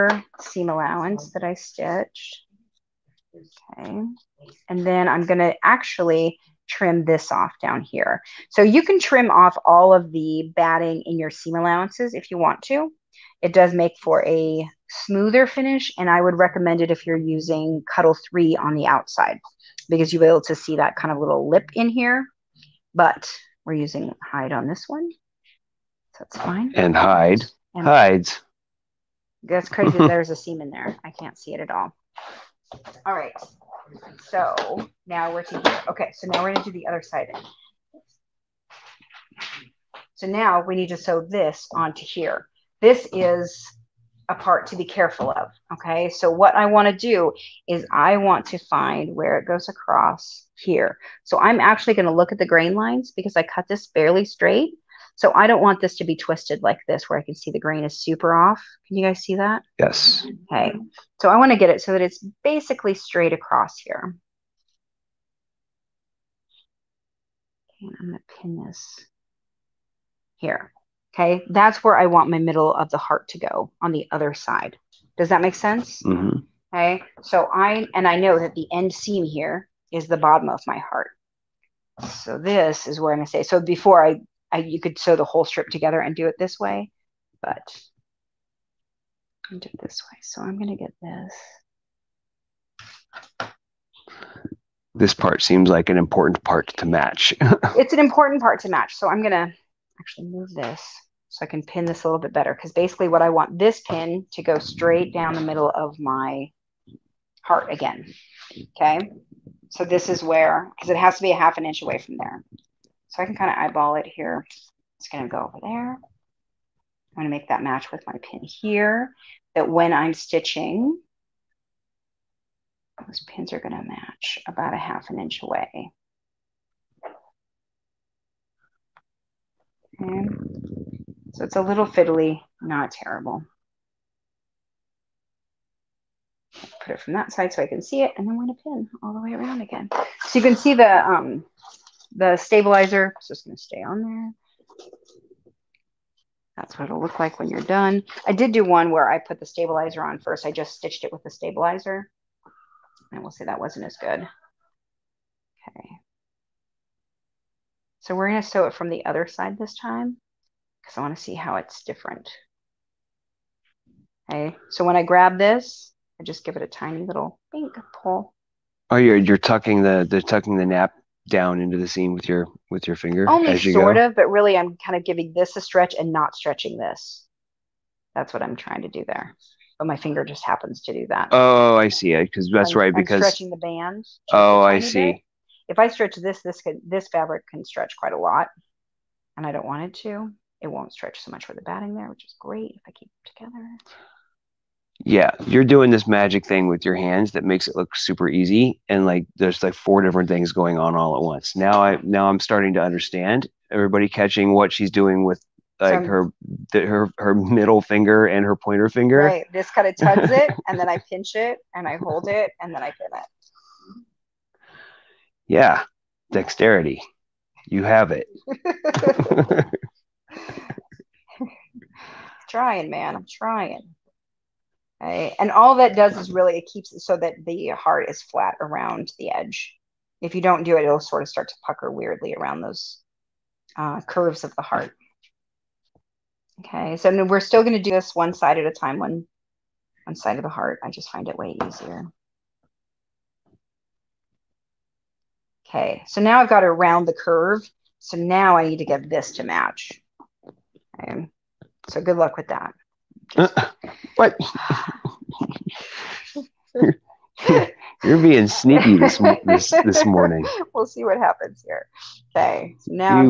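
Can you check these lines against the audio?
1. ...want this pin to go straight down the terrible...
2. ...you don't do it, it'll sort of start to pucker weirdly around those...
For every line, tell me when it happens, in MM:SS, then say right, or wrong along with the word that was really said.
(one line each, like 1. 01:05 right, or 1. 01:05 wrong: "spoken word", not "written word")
1. 01:43 wrong: "middle", not "terrible"
2. 03:50 right.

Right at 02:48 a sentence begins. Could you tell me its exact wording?
Oh, you're you're tucking the the tucking the nap down into the seam with your with your finger.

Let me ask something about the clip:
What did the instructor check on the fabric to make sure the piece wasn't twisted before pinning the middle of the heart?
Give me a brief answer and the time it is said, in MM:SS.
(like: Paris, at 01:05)
Grain lines, at 00:52.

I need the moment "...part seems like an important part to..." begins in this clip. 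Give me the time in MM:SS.
01:35.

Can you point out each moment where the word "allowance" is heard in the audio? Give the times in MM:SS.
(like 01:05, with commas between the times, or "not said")
00:00, 00:11.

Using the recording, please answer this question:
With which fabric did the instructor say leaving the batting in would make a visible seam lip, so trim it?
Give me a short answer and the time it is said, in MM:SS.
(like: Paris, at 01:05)
Cuddle 3, at 00:17.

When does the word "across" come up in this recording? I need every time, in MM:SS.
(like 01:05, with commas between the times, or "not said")
00:49, 01:03.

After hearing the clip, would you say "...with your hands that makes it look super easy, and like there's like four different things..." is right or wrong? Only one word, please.
right.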